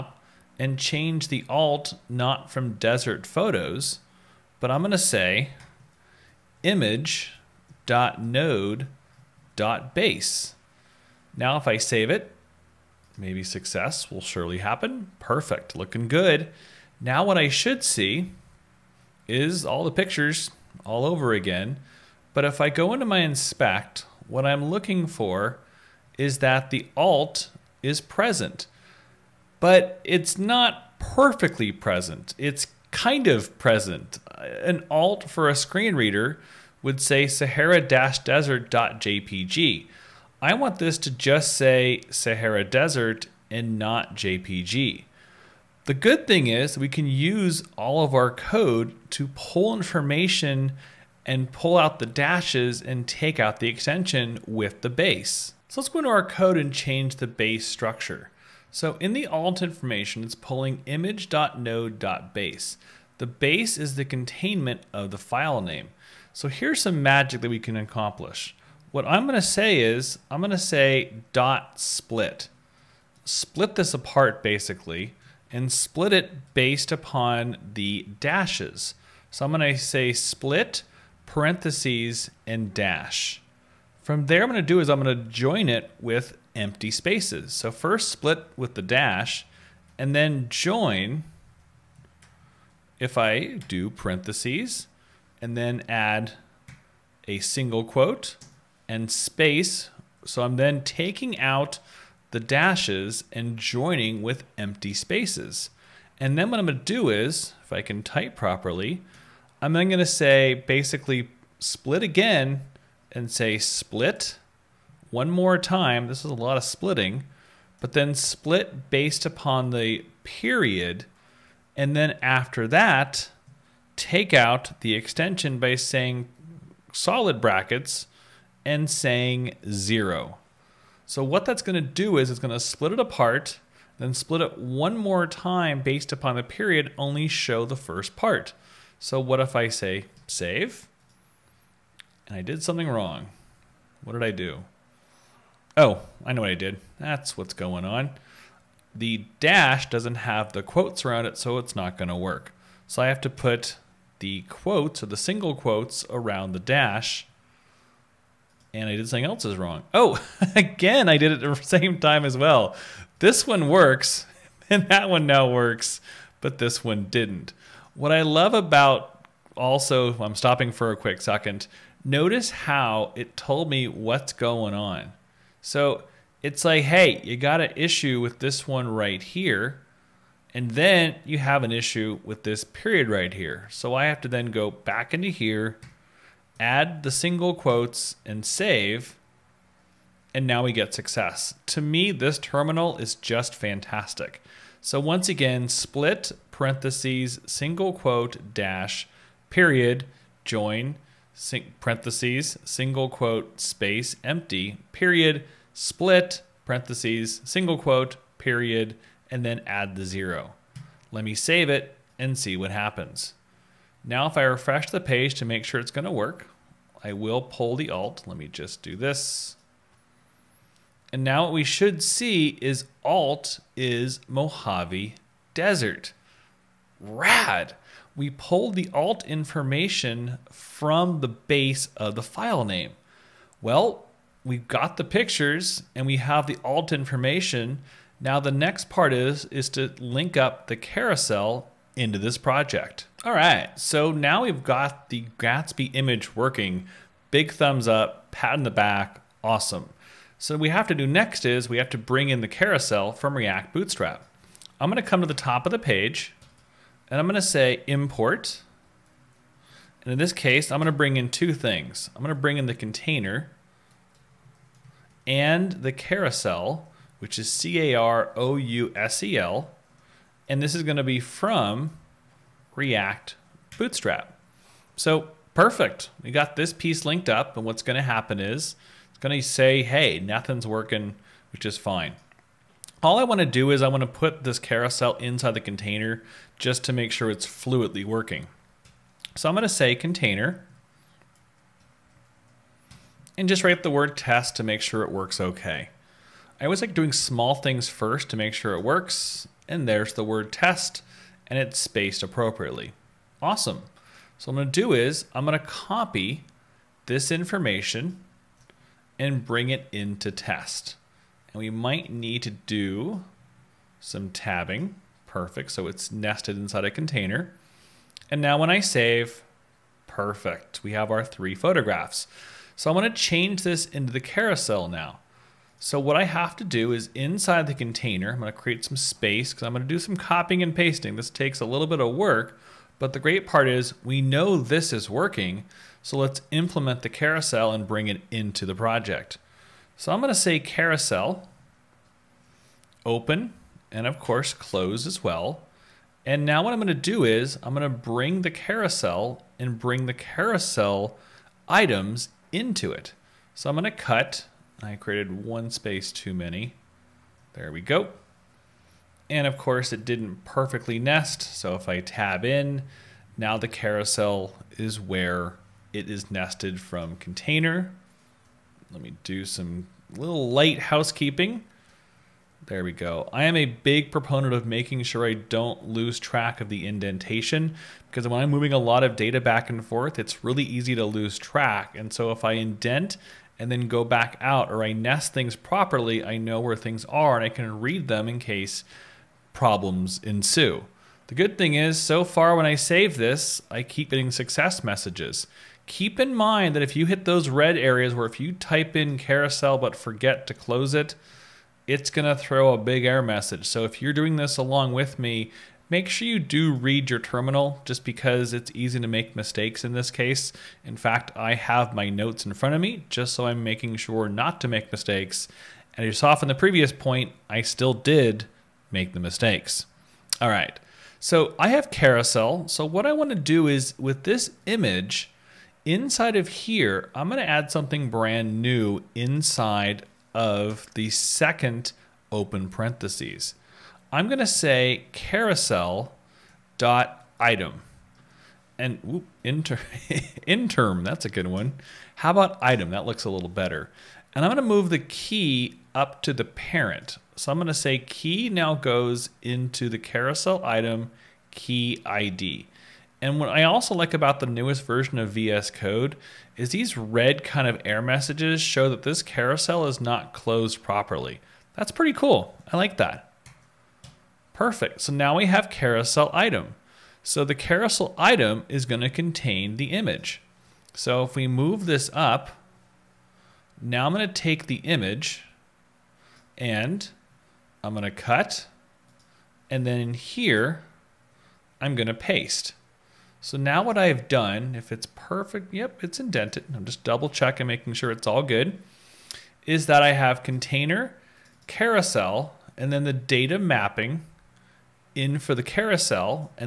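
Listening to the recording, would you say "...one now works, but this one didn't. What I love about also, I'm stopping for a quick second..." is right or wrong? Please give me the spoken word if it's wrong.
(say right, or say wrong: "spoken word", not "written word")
right.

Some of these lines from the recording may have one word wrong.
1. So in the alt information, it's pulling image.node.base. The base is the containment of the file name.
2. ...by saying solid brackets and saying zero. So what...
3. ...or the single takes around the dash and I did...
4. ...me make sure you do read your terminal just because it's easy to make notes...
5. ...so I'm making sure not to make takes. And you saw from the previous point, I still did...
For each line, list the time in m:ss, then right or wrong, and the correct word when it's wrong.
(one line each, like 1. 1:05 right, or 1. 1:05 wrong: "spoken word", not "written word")
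1. 0:58 right
2. 2:05 right
3. 2:35 wrong: "quotes", not "takes"
4. 6:45 wrong: "mistakes", not "notes"
5. 6:53 wrong: "mistakes", not "takes".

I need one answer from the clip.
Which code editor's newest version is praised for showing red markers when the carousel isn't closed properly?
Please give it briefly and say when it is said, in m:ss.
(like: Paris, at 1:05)
VS Code, at 7:35.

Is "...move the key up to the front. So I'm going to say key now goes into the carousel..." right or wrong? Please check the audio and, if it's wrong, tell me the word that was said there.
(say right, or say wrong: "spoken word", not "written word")
wrong: "parent", not "front".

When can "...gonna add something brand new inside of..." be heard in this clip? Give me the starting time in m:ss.
7:07.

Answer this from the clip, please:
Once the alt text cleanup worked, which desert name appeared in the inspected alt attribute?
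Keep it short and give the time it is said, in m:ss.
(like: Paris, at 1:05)
Mojave Desert, at 3:44.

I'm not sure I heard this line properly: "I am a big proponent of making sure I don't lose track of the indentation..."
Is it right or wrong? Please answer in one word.
right.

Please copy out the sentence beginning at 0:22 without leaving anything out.
But if I go into my inspect, what I'm looking for is that the alt is present.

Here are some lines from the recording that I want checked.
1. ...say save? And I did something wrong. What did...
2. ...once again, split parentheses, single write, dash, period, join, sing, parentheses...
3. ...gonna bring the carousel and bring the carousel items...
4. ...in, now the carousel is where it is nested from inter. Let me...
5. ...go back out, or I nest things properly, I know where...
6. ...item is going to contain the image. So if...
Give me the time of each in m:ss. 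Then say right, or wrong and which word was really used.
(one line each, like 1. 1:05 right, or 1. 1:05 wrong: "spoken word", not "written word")
1. 2:19 right
2. 3:15 wrong: "quote", not "write"
3. 5:47 right
4. 6:02 wrong: "container", not "inter"
5. 6:23 right
6. 7:48 right.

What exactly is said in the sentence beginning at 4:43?
All I want to do is I want to put this carousel inside the container just to make sure it's fluidly working.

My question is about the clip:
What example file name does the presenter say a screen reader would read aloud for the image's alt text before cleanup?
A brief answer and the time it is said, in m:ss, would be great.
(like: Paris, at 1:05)
sahara-desert.jpg, at 0:37.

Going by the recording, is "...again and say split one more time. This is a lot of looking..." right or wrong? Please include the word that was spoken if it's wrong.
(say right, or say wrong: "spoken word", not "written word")
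wrong: "splitting", not "looking".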